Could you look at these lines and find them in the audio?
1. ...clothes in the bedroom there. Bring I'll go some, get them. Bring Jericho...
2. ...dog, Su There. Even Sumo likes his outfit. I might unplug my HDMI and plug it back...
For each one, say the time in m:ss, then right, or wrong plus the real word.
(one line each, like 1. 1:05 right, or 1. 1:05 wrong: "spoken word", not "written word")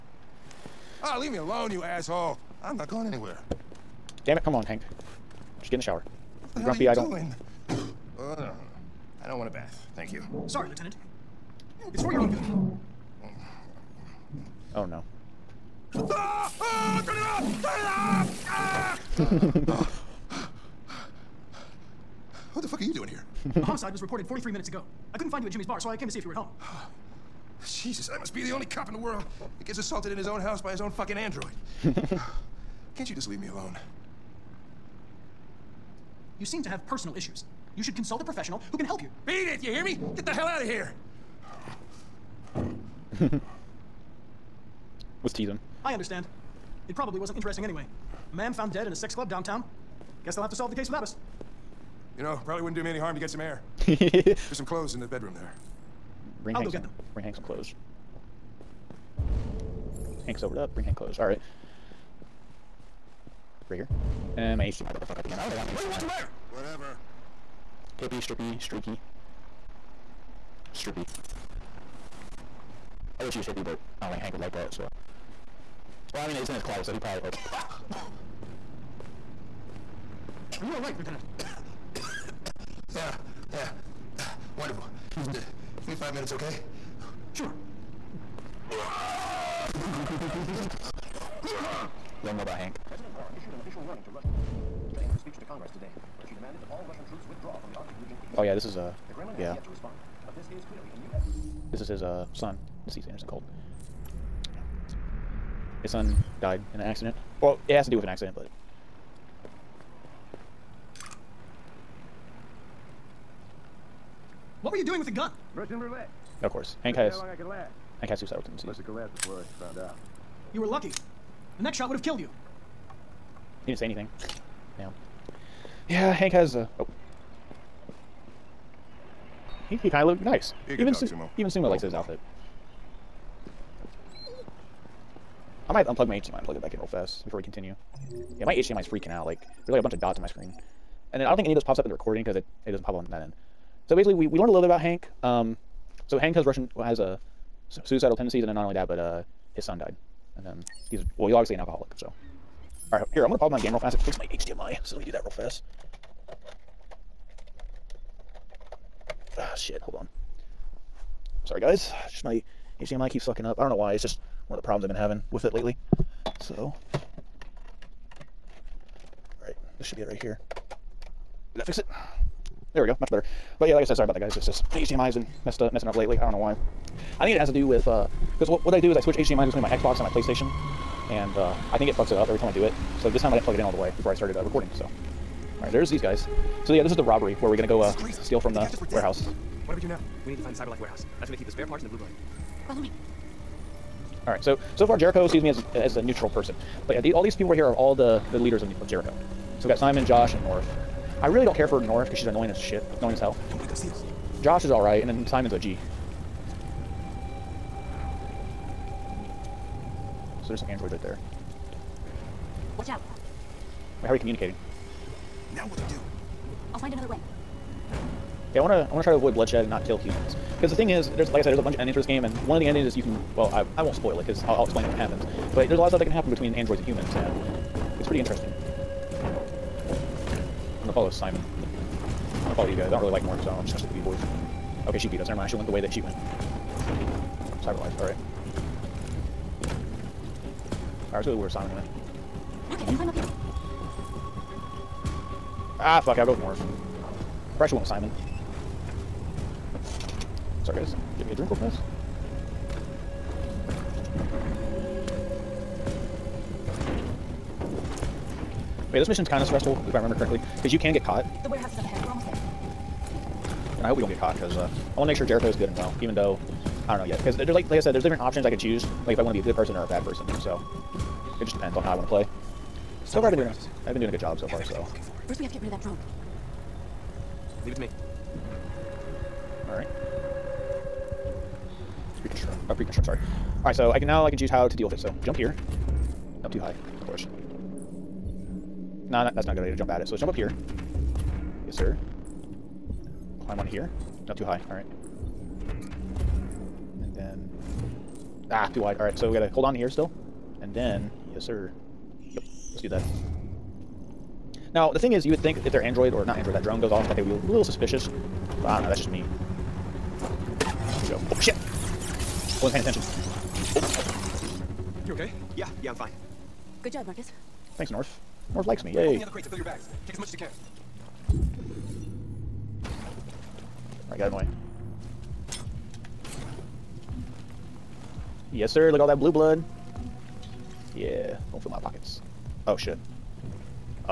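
1. 0:54 wrong: "Hank", not "Jericho"
2. 2:10 wrong: "Sumo", not "There".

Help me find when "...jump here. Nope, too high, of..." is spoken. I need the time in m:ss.
4:45.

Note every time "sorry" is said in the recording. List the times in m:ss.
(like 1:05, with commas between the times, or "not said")
0:10, 2:41, 2:53, 4:10, 4:43.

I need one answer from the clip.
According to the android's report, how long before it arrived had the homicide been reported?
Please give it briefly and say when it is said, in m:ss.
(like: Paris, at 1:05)
43 minutes, at 0:24.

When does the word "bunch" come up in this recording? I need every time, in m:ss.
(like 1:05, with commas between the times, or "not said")
2:19, 3:41.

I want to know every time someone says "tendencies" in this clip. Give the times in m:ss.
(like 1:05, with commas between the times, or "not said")
1:58, 2:28.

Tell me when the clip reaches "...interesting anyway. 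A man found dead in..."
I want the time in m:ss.
0:47.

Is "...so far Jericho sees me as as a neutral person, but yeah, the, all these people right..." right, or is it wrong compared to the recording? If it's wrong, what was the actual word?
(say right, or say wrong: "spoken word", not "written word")
right.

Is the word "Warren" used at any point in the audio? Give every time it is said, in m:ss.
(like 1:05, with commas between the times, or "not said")
1:33.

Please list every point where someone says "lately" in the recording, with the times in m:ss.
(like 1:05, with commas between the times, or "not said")
2:45, 2:55.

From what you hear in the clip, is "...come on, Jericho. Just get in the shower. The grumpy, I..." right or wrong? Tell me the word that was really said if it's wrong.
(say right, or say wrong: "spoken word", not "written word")
wrong: "Hank", not "Jericho".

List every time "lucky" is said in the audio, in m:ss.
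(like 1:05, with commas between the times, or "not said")
2:00.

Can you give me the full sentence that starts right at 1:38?
Oh yeah, this is uh yeah.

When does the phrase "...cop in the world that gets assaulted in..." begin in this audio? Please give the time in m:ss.
0:28.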